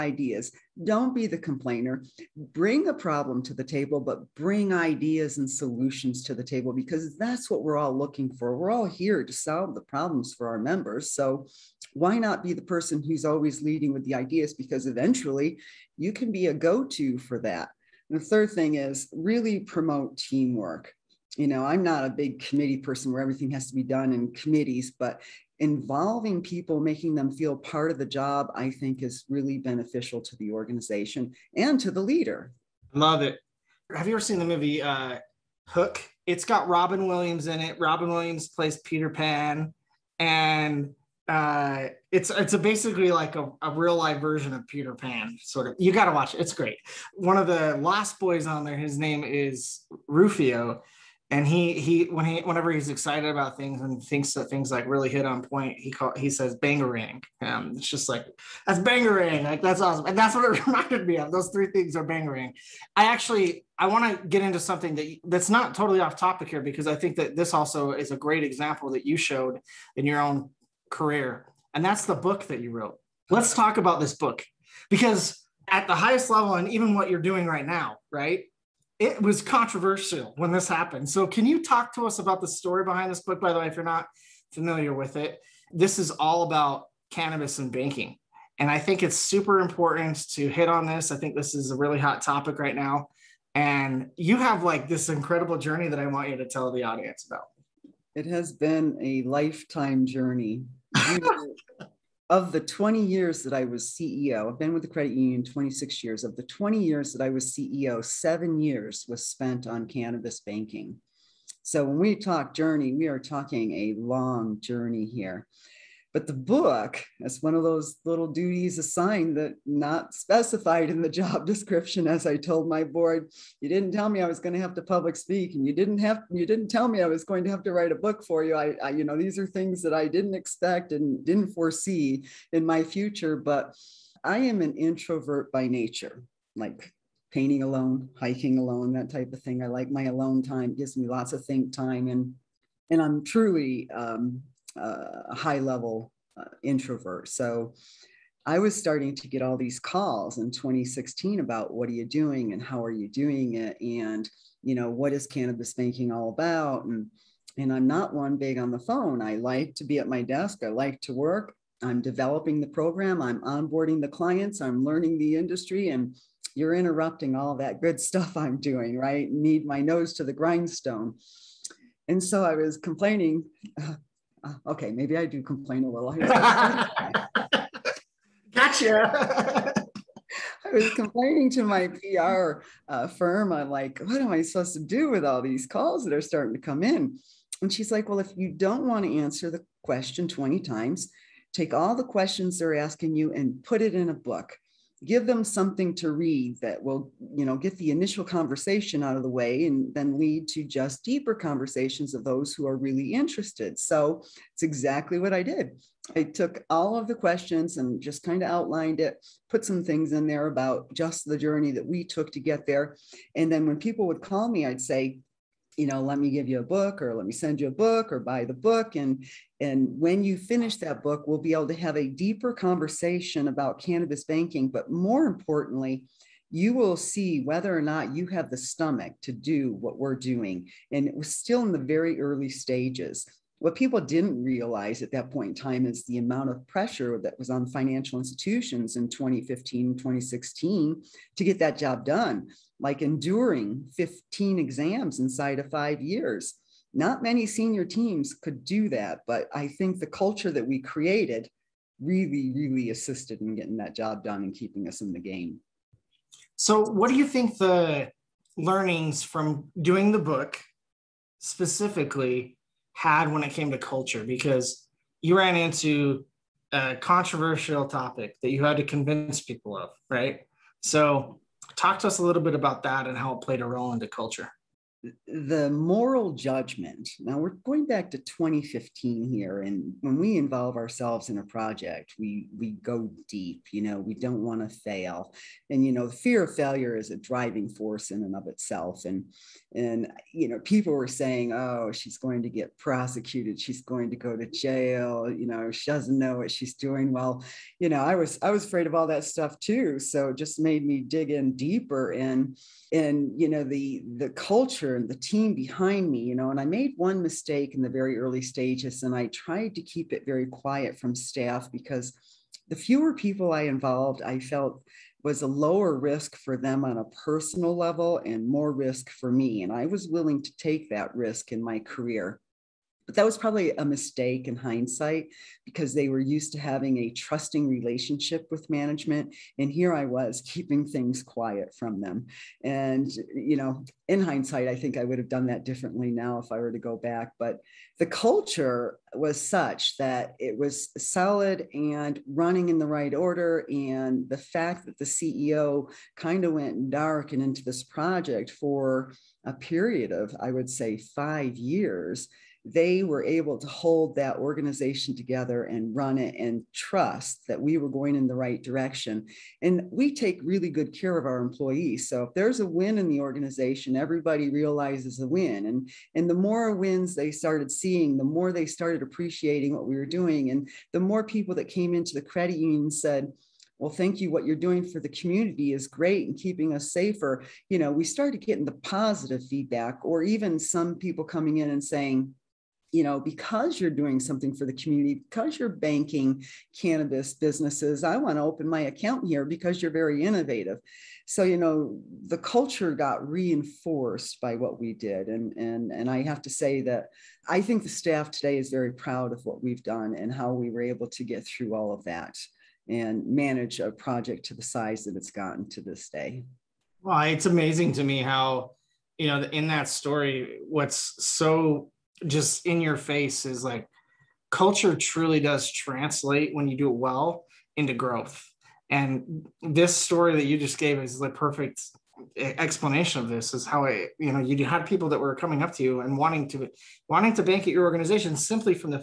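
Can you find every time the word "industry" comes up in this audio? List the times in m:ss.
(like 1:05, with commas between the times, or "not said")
2:45.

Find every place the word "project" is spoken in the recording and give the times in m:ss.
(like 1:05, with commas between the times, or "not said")
4:41, 5:47, 6:43.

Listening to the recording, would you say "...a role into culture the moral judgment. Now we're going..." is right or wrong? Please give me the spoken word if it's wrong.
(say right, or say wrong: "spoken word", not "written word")
right.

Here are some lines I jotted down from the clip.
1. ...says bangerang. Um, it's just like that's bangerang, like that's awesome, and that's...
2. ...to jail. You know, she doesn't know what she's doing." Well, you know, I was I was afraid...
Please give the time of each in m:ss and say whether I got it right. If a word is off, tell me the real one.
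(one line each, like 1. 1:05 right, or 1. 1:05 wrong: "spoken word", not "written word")
1. 0:56 right
2. 4:54 right.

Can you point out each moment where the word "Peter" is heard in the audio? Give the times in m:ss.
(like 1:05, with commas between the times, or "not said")
0:38, 0:44.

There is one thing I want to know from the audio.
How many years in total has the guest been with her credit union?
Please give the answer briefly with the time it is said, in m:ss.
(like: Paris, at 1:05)
26 years, at 1:45.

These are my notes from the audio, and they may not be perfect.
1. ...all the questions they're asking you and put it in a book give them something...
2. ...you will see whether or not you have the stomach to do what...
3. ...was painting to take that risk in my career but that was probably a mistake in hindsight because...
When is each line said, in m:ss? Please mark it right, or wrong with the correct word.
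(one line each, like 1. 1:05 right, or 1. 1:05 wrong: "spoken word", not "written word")
1. 3:11 right
2. 3:46 right
3. 5:19 wrong: "willing", not "painting".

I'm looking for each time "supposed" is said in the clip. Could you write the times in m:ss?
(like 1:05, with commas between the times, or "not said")
3:04.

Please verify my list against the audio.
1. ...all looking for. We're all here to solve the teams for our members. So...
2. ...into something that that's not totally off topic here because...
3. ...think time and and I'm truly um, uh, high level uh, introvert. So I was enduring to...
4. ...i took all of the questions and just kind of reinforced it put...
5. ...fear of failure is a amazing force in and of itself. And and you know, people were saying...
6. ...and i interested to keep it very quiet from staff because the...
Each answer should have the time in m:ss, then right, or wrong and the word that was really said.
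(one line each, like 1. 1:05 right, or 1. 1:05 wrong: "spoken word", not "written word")
1. 0:07 wrong: "problems", not "teams"
2. 1:04 right
3. 2:21 wrong: "starting", not "enduring"
4. 3:26 wrong: "outlined", not "reinforced"
5. 4:46 wrong: "driving", not "amazing"
6. 5:09 wrong: "tried", not "interested".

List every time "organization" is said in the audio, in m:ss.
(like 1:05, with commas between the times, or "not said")
0:30, 5:54, 6:03, 7:07.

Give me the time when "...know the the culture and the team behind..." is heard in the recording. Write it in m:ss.
5:03.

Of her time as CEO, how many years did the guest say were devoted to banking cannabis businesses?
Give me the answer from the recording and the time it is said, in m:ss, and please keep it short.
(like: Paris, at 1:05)
7 years, at 1:48.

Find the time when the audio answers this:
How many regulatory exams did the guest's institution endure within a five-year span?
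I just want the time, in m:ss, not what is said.
4:03.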